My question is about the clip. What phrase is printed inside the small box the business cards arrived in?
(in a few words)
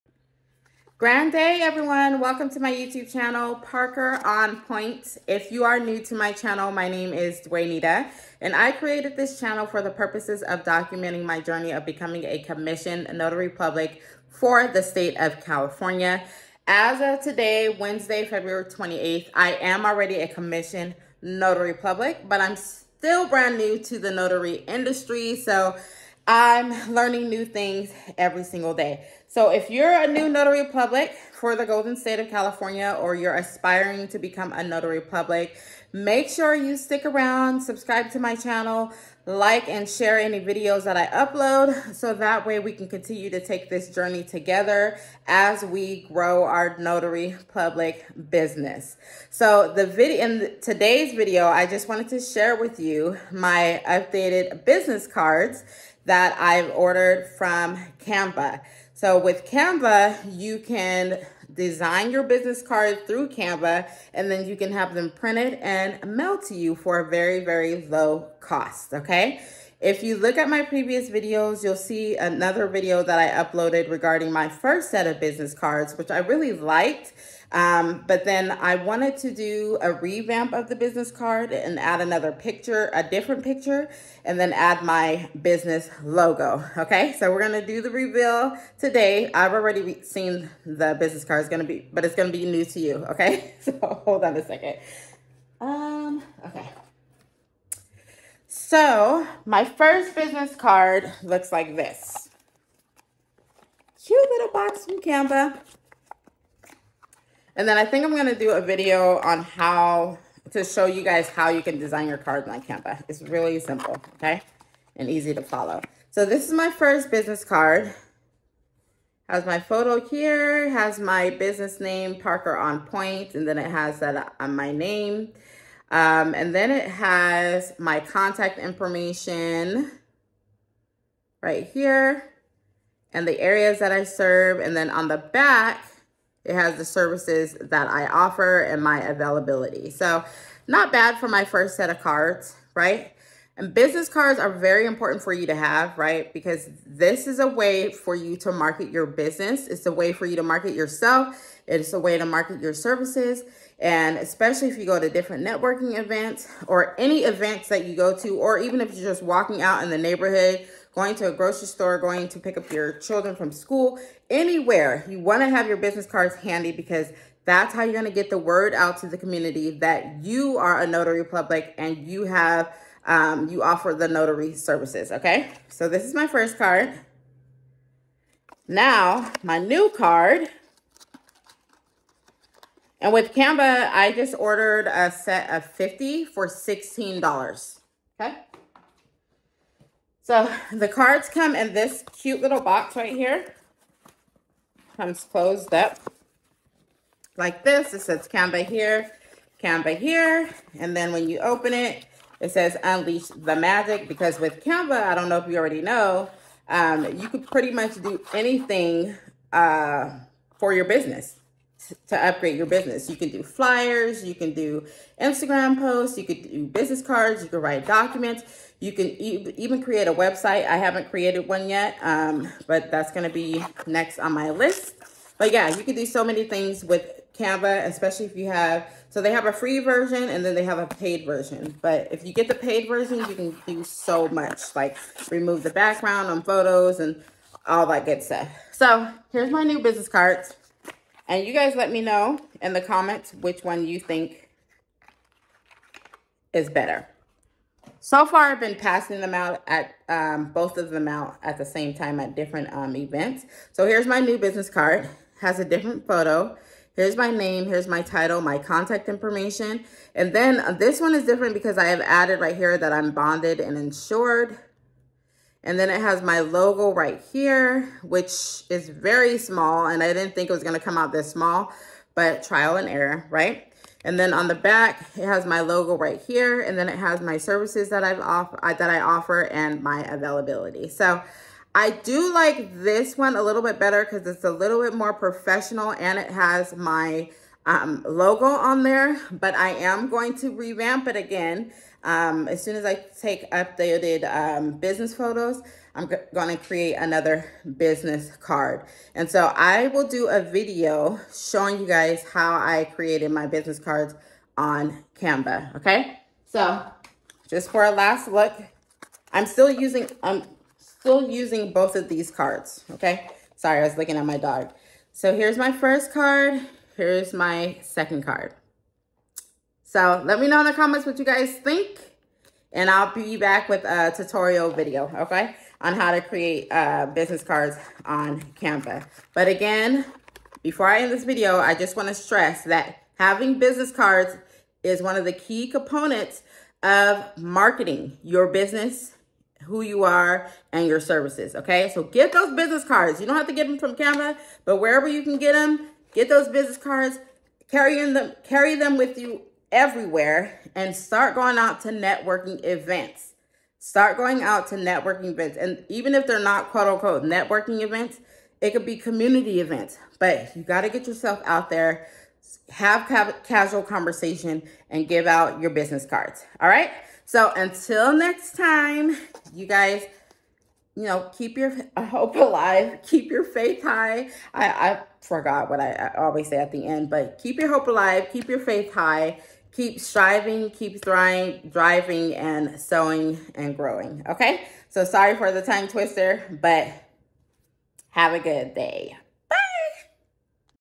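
unleash the magic.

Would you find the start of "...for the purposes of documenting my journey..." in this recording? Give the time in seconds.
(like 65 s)
9 s.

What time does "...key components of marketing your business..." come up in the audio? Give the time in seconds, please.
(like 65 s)
335 s.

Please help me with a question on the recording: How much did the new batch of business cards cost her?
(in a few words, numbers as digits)
$16.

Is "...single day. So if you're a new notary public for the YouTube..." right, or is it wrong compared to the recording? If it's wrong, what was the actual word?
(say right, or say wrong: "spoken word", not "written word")
wrong: "Golden", not "YouTube".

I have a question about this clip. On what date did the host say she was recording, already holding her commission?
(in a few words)
Wednesday, February 28th.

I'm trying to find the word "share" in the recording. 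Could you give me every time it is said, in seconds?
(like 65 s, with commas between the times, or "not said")
39 s, 52 s.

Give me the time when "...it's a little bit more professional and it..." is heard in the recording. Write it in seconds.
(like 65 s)
284 s.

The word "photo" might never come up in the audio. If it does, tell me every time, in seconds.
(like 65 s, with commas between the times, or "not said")
119 s, 236 s, 256 s, 295 s.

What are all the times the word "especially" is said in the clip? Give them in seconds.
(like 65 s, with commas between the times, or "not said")
154 s, 227 s.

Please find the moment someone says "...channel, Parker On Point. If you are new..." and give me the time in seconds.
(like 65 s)
3 s.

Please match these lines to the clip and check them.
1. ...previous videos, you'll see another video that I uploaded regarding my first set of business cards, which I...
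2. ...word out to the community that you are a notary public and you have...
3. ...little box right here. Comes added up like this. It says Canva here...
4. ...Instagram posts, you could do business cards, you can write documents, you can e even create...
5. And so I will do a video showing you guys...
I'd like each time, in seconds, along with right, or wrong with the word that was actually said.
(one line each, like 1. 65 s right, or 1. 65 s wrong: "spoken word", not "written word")
1. 70 s right
2. 168 s right
3. 192 s wrong: "closed", not "added"
4. 215 s right
5. 299 s right.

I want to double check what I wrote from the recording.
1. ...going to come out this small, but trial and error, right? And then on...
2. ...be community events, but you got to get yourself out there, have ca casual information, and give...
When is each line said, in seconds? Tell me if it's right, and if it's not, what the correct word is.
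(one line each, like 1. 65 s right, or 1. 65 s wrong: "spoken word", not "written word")
1. 270 s right
2. 358 s wrong: "conversation", not "information".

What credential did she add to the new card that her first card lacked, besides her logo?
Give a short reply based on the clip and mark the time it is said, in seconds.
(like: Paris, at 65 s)
bonded and insured, at 263 s.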